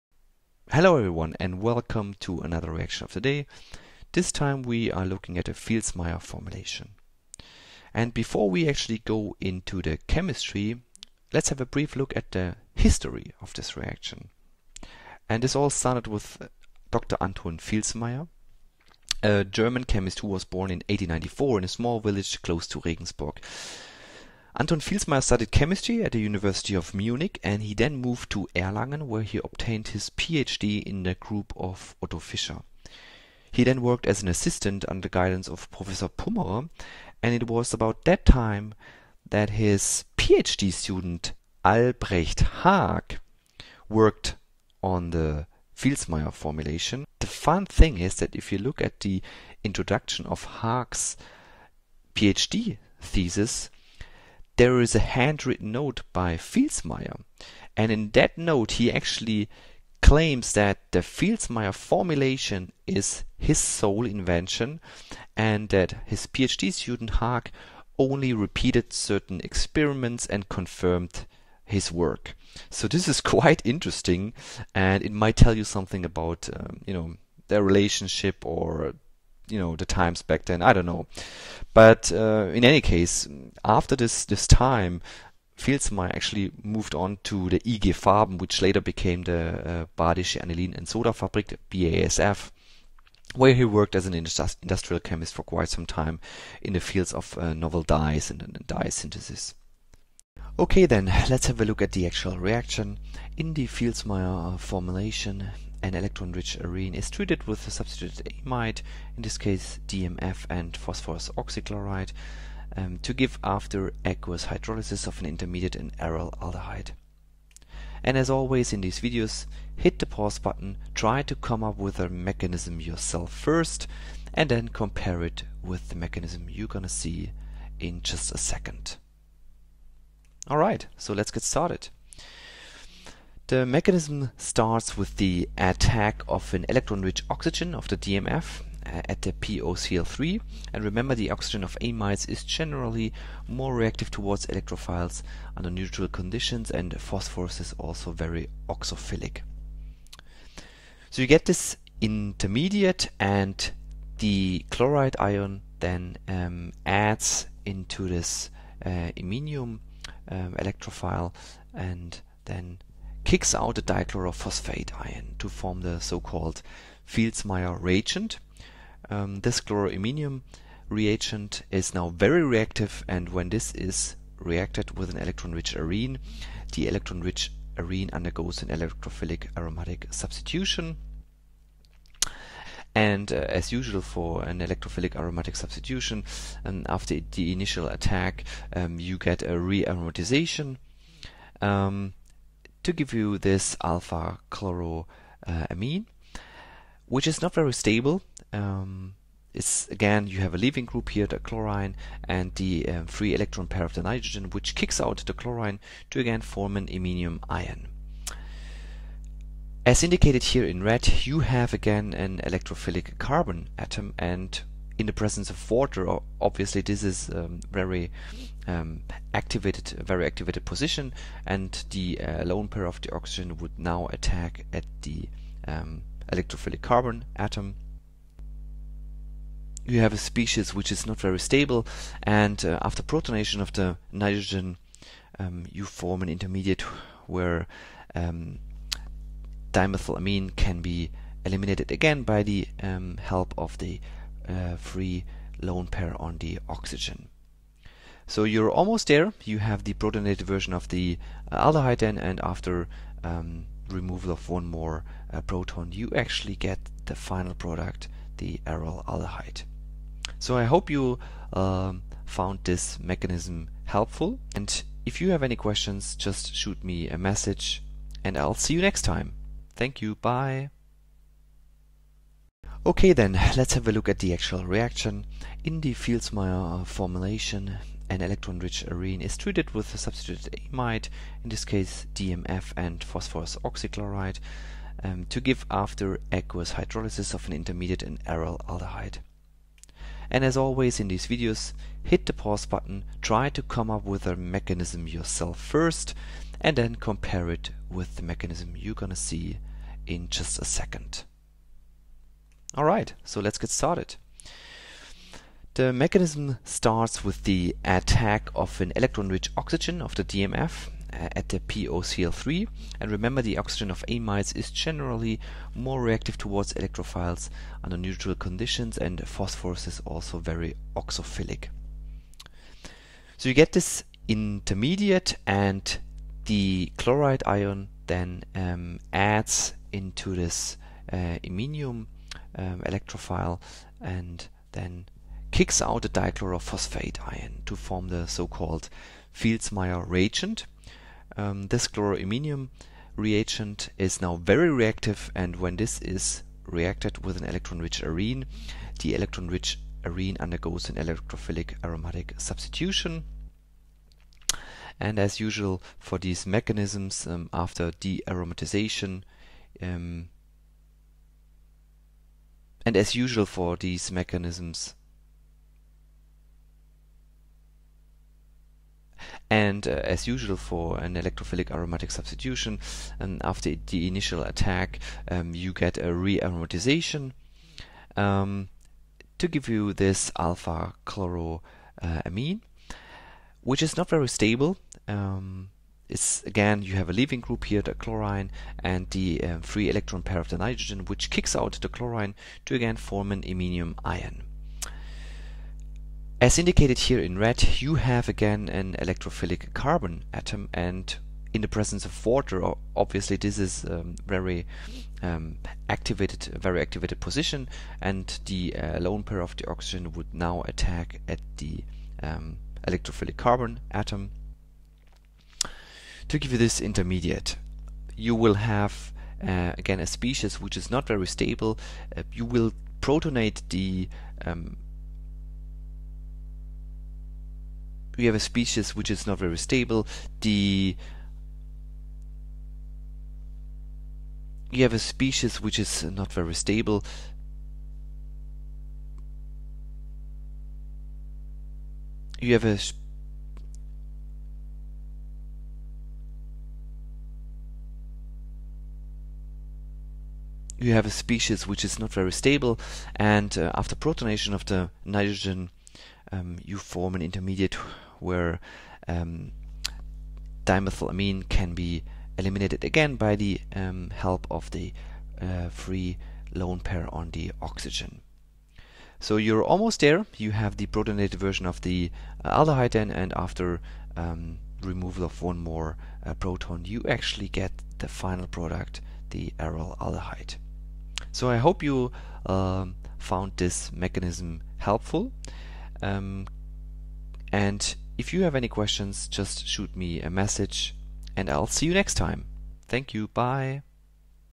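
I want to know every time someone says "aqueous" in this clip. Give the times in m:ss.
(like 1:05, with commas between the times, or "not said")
1:54, 4:46.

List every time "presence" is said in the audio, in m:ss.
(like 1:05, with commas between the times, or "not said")
3:35, 6:41.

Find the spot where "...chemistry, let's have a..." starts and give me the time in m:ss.
0:10.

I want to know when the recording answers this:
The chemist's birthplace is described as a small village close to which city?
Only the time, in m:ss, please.
0:22.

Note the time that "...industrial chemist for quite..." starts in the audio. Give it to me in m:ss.
1:34.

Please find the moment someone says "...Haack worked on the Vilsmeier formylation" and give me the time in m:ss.
0:42.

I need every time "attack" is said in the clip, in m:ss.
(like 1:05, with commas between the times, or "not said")
2:15, 3:07, 3:44, 5:07, 6:14, 6:50.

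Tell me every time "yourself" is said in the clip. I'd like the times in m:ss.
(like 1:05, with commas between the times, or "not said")
2:02, 4:55.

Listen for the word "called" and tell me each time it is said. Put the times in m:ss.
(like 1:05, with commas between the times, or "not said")
2:45, 5:38.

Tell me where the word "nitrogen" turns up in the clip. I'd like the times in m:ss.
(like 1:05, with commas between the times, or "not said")
3:24, 3:54, 6:30, 7:35.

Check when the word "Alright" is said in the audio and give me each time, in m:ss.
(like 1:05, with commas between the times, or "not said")
2:10, 5:02.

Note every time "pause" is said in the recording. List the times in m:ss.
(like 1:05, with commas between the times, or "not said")
2:00, 4:52.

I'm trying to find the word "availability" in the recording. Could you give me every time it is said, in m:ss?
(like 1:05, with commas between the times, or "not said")
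not said.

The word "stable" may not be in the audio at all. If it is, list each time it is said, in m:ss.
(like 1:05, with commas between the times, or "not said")
3:17, 3:51, 6:24, 7:01, 7:09, 7:16, 7:32.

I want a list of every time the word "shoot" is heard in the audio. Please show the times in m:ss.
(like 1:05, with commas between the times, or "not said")
4:26, 8:09.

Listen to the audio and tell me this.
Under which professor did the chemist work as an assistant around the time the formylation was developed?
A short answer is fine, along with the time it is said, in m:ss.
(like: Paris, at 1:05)
Pummerer, at 0:36.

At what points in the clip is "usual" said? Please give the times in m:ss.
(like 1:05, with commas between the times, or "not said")
3:03, 5:55, 6:03, 6:10.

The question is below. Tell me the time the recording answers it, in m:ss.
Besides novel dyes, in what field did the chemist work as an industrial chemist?
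1:38.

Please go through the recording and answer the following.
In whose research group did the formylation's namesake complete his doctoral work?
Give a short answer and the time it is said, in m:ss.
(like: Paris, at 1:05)
Otto Fischer, at 0:32.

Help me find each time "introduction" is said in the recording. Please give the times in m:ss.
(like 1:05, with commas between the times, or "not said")
0:49.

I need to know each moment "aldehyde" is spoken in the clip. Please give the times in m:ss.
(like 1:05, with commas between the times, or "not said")
1:56, 4:11, 4:19, 4:48, 7:52, 7:59.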